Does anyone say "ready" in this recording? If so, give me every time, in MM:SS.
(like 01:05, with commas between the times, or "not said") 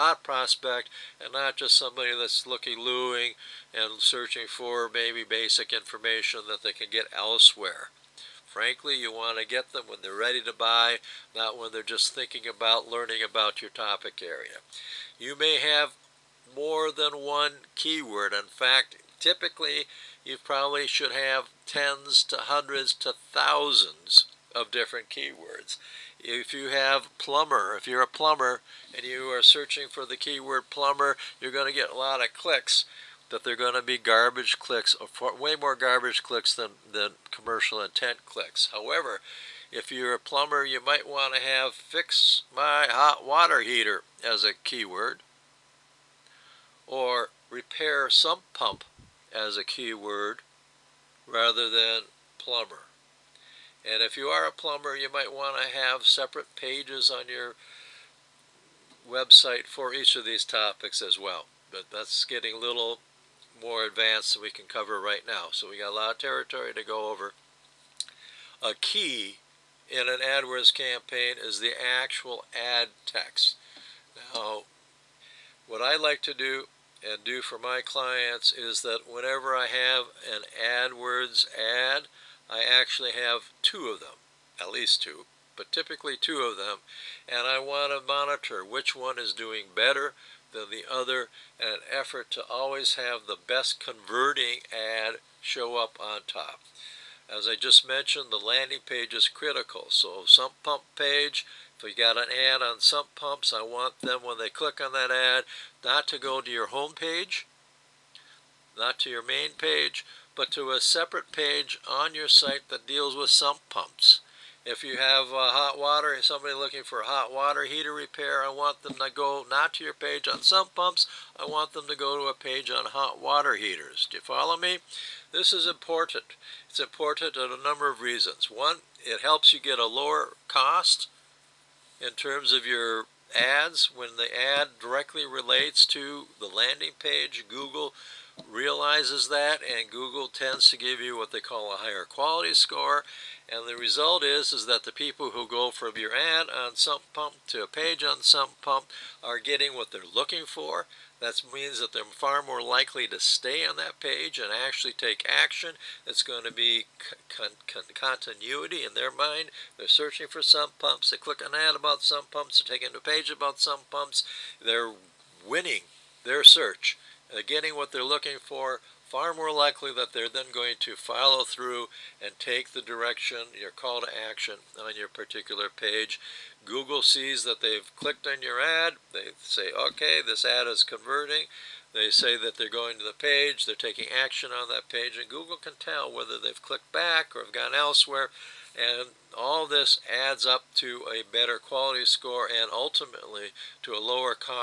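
00:10.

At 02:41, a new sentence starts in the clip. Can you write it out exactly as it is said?
They click an ad about sump pumps.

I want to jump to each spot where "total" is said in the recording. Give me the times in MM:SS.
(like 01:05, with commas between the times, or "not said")
not said.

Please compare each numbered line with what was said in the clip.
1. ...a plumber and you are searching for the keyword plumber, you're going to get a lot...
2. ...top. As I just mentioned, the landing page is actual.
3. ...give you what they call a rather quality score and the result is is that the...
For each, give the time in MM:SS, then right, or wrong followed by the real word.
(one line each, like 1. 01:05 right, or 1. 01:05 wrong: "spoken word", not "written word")
1. 00:28 right
2. 01:36 wrong: "critical", not "actual"
3. 02:20 wrong: "higher", not "rather".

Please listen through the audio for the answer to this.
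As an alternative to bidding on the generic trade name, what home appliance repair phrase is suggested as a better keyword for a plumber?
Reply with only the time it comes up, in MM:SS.
00:41.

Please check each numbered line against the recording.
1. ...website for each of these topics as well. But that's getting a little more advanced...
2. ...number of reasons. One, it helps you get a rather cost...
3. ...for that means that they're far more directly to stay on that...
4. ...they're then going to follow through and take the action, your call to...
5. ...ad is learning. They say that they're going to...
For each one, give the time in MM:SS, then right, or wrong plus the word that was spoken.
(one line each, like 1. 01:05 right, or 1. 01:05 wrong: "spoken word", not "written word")
1. 00:59 right
2. 02:07 wrong: "lower", not "rather"
3. 02:30 wrong: "likely", not "directly"
4. 02:50 wrong: "direction", not "action"
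5. 03:00 wrong: "converting", not "learning".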